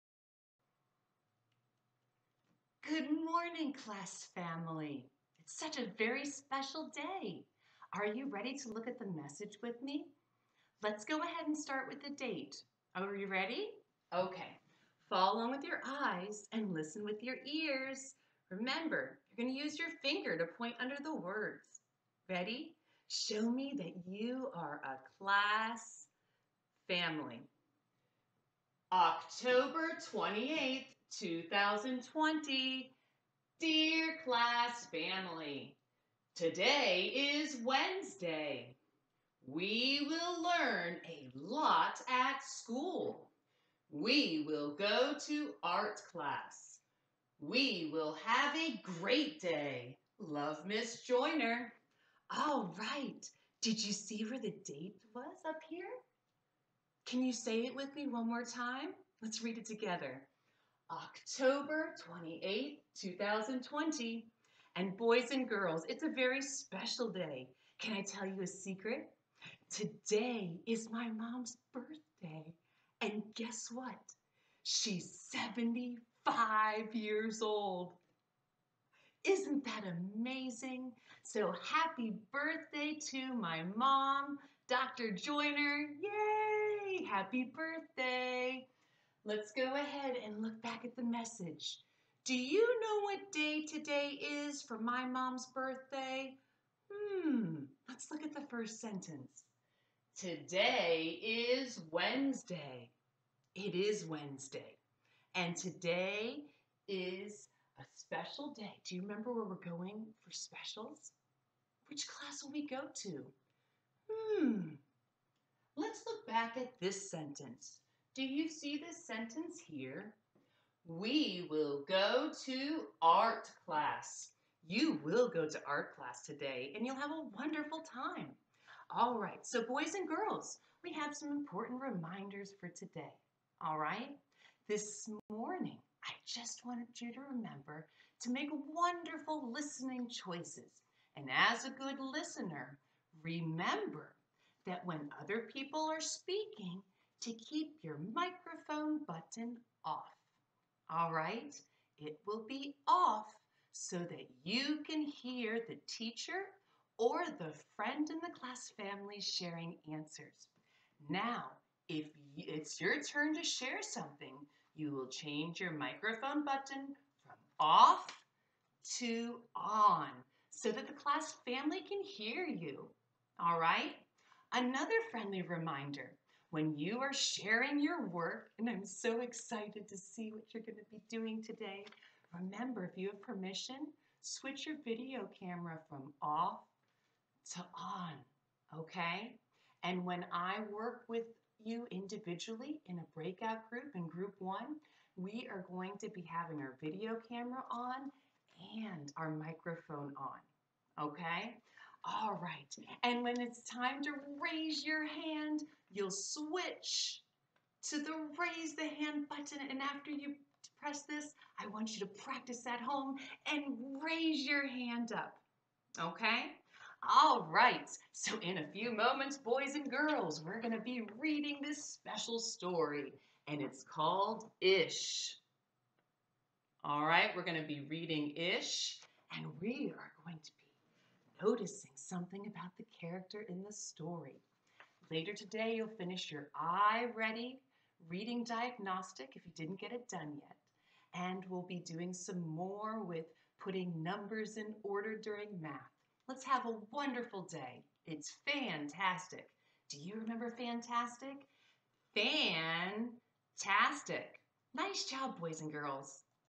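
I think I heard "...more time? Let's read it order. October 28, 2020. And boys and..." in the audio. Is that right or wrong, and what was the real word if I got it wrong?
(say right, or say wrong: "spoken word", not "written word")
wrong: "together", not "order".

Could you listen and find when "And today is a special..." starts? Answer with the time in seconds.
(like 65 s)
105 s.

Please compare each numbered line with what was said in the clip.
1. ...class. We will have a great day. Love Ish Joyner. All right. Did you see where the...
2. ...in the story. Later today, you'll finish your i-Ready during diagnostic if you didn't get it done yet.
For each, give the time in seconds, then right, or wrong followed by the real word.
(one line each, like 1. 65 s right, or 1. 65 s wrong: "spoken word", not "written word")
1. 46 s wrong: "Miss", not "Ish"
2. 233 s wrong: "reading", not "during".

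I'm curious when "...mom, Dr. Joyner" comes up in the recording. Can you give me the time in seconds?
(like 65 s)
83 s.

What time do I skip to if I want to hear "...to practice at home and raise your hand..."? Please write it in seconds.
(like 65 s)
211 s.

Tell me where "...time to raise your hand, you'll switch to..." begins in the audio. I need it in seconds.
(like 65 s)
203 s.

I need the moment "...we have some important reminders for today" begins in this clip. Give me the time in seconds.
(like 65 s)
130 s.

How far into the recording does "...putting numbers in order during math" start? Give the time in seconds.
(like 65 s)
243 s.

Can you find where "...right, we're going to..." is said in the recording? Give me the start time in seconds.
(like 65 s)
227 s.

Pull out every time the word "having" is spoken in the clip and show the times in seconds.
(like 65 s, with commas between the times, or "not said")
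196 s.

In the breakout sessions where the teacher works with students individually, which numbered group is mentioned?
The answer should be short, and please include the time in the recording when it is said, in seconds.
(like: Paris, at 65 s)
group 1, at 194 s.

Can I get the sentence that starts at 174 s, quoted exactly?
Another friendly reminder when you are sharing your work.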